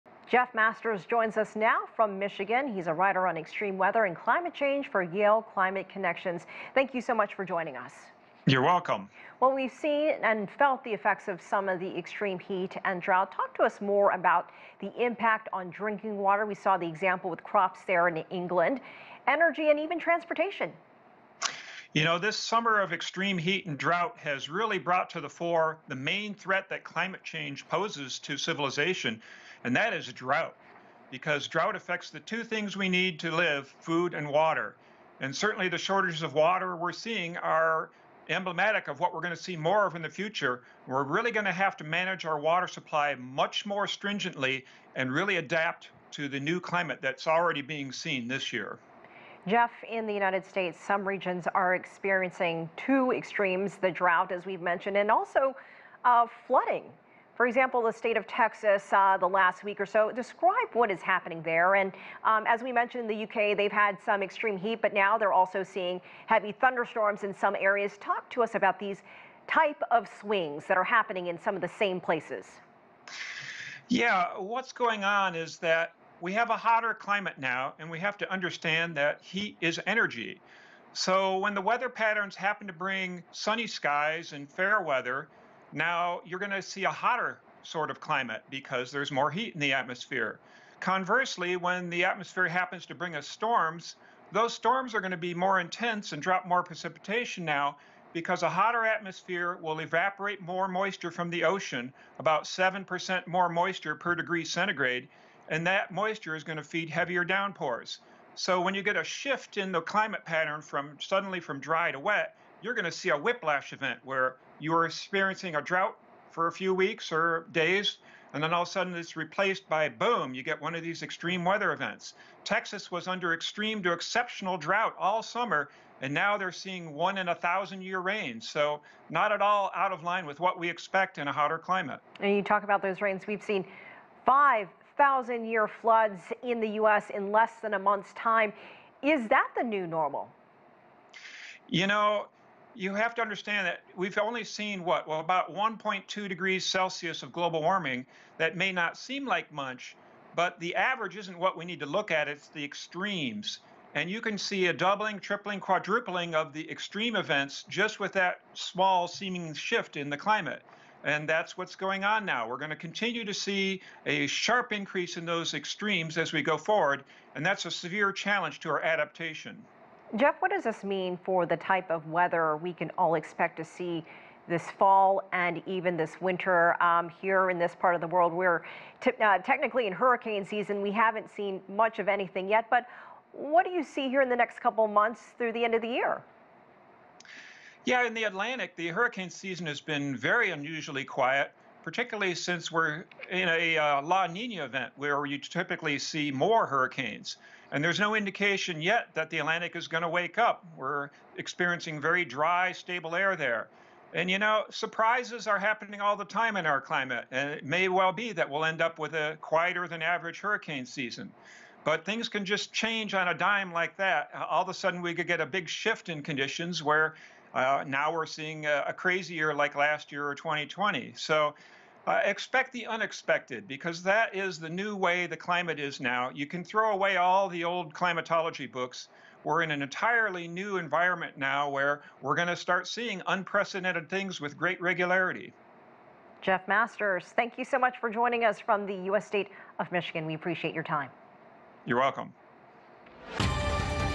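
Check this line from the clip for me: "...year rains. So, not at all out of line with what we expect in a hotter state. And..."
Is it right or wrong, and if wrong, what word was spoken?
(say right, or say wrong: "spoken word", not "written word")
wrong: "climate", not "state".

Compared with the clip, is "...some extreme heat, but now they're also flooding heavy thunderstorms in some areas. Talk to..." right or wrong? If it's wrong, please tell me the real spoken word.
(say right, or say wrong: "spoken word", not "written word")
wrong: "seeing", not "flooding".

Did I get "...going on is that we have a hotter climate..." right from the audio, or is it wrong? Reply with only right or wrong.
right.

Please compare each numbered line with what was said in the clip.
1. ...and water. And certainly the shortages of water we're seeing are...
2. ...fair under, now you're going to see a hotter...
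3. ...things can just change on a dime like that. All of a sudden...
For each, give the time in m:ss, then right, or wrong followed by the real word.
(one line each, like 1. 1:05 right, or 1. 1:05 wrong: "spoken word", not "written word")
1. 0:34 right
2. 1:24 wrong: "weather", not "under"
3. 3:32 right.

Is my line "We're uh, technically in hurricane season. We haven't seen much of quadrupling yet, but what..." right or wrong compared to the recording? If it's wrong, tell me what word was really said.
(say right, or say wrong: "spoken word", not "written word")
wrong: "anything", not "quadrupling".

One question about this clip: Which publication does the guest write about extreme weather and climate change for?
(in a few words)
Yale Climate Connections.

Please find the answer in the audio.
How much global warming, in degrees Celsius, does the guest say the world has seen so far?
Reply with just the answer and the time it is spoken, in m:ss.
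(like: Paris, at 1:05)
1.2 degrees Celsius, at 2:25.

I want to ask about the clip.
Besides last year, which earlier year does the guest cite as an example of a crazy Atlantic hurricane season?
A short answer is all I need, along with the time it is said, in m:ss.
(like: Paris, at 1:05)
2020, at 3:40.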